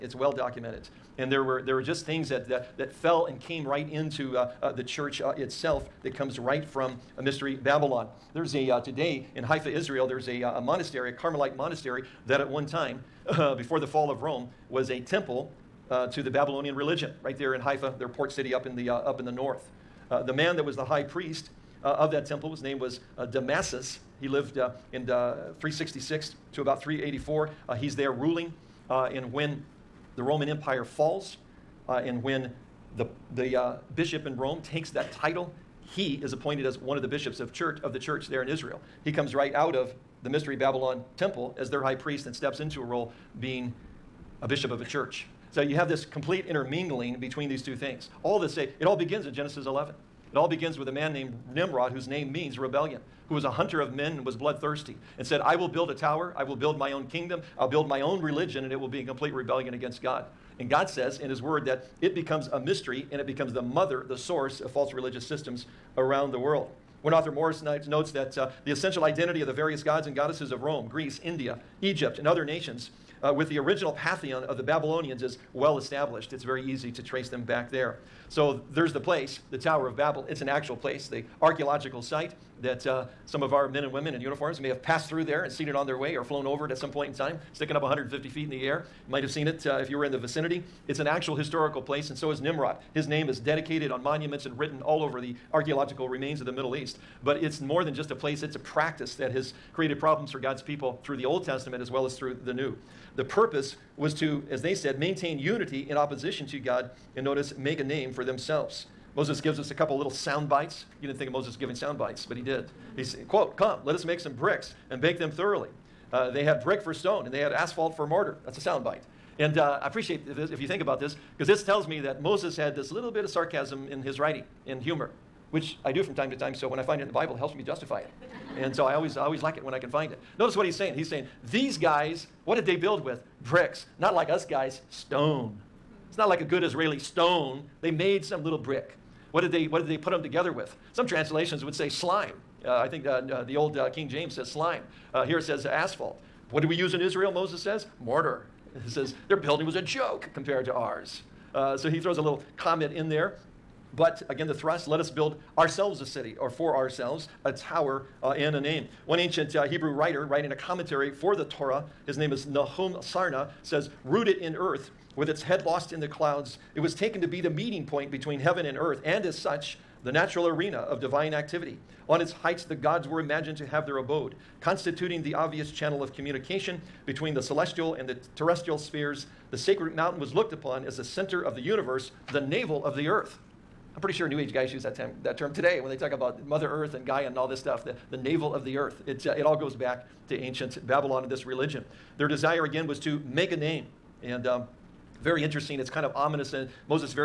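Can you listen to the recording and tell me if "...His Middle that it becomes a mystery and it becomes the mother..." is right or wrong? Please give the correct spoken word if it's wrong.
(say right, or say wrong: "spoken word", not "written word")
wrong: "Word", not "Middle".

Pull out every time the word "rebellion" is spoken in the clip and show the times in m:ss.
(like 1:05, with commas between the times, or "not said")
0:52, 0:59.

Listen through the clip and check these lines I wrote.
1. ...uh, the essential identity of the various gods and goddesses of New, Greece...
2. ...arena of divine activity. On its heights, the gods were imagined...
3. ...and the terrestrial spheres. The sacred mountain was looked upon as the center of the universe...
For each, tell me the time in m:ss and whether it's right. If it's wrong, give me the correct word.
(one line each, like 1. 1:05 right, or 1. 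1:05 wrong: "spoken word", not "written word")
1. 1:08 wrong: "Rome", not "New"
2. 2:50 right
3. 2:57 right.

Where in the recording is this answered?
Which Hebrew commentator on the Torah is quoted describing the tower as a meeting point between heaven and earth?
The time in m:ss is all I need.
2:42.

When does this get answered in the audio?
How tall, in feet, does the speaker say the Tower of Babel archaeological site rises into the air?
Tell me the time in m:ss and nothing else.
1:27.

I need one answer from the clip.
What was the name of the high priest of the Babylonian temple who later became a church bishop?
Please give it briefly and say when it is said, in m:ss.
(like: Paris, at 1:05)
Damasus, at 0:23.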